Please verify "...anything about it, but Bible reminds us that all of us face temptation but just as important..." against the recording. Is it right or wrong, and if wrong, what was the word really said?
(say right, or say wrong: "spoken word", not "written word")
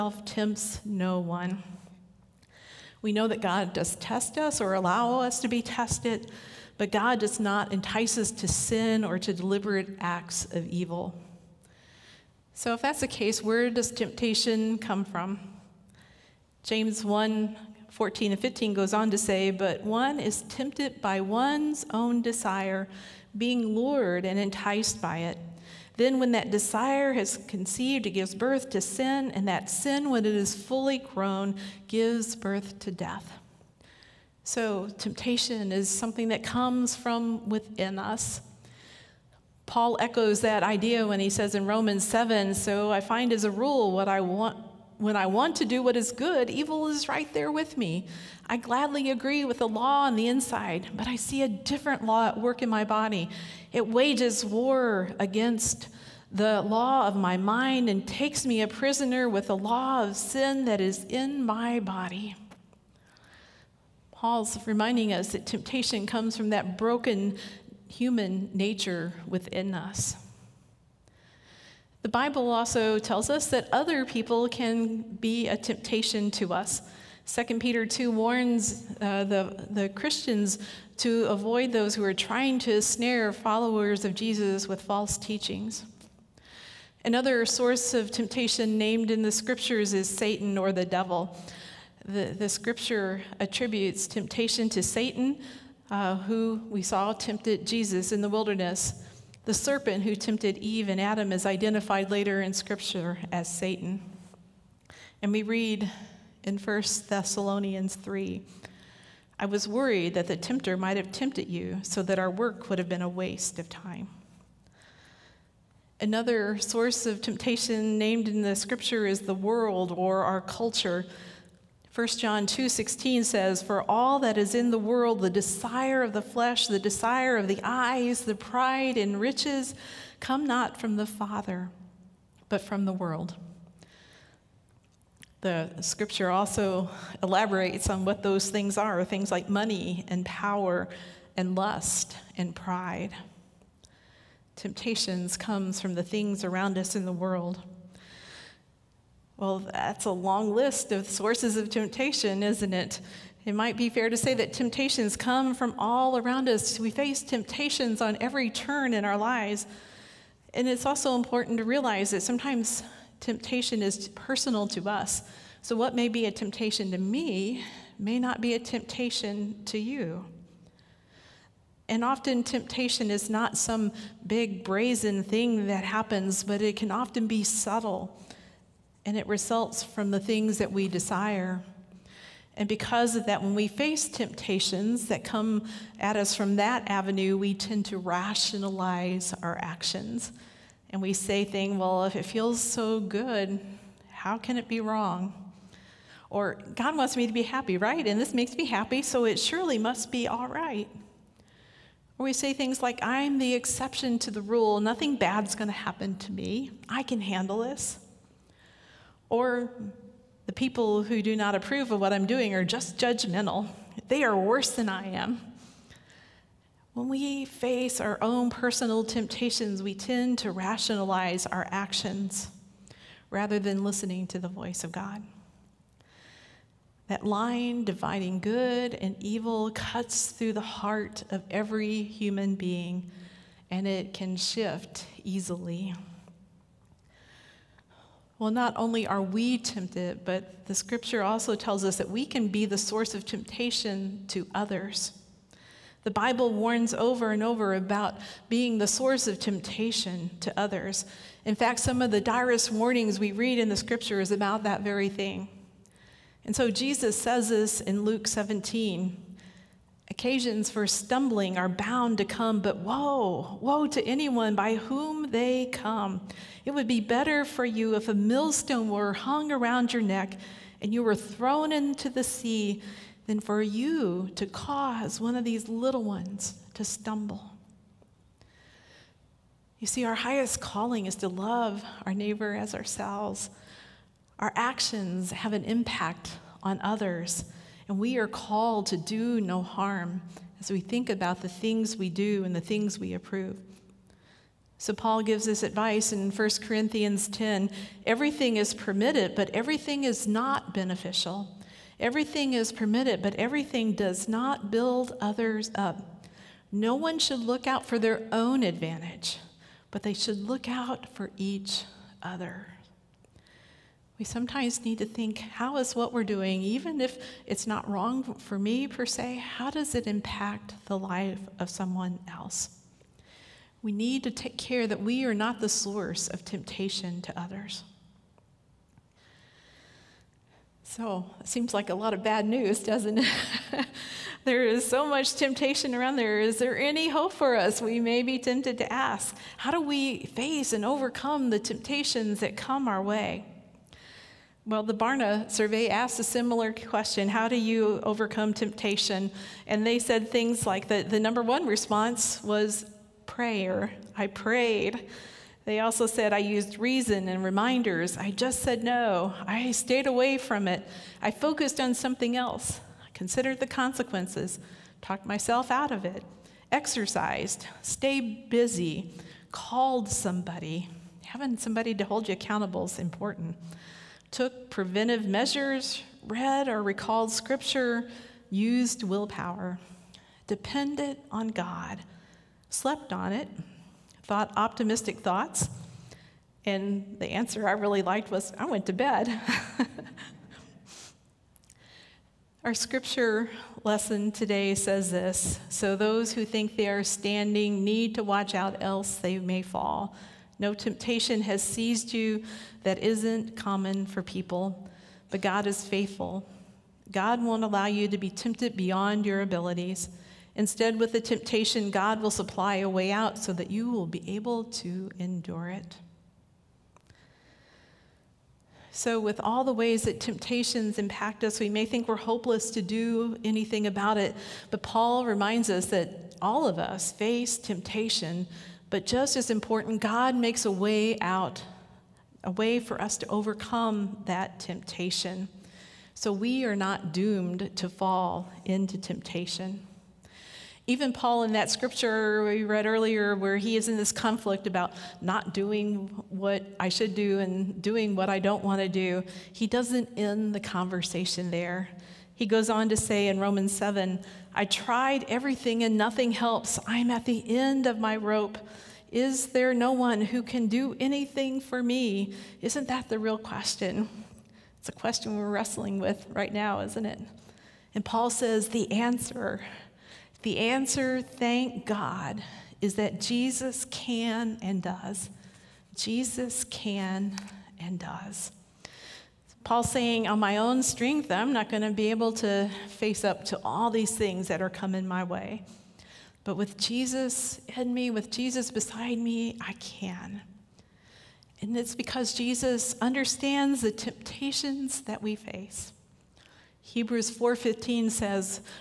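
wrong: "Paul", not "Bible".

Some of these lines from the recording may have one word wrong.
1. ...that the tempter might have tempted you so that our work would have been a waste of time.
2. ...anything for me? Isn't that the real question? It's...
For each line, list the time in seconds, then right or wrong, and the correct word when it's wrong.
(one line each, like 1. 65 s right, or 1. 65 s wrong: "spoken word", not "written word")
1. 110 s right
2. 460 s right.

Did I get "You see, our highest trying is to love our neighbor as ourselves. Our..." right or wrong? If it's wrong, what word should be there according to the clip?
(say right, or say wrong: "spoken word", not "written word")
wrong: "calling", not "trying".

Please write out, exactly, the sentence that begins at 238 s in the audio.
Well, not only are we tempted, but the scripture also tells us that we can be the source of temptation to others.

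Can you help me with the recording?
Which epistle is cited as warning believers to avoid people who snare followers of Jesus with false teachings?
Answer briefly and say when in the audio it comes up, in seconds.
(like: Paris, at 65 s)
2 Peter, at 77 s.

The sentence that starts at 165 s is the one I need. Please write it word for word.
So, what may be a temptation to me may not be a temptation to you.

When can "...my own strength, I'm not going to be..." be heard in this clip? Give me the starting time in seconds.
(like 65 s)
480 s.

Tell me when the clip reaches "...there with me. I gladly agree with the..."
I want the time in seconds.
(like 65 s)
47 s.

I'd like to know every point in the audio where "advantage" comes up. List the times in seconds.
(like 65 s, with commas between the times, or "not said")
308 s.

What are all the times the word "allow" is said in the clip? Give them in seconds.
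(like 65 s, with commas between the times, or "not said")
4 s, 407 s.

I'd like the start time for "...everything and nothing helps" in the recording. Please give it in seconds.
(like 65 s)
455 s.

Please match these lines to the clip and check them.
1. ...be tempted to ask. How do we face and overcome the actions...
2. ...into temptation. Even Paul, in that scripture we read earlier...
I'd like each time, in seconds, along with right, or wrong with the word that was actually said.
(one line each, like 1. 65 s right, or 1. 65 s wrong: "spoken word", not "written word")
1. 338 s wrong: "temptations", not "actions"
2. 438 s right.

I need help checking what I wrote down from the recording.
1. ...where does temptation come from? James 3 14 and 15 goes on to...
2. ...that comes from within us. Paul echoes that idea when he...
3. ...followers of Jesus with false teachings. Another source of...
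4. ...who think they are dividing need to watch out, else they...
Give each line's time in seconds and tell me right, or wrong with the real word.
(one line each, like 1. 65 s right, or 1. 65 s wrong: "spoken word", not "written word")
1. 13 s wrong: "1", not "3"
2. 36 s right
3. 83 s right
4. 396 s wrong: "standing", not "dividing".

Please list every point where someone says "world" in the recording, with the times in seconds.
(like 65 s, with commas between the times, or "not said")
119 s, 124 s, 132 s, 147 s.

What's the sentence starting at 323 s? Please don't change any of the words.
We need to take care that we are not the source of temptation to others.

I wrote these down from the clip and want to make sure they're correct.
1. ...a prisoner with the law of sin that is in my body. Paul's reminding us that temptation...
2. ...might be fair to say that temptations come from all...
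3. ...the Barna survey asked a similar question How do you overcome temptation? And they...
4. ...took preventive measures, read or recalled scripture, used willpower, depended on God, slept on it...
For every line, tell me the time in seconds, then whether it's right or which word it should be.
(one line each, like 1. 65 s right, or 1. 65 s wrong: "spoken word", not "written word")
1. 58 s right
2. 153 s right
3. 344 s right
4. 374 s right.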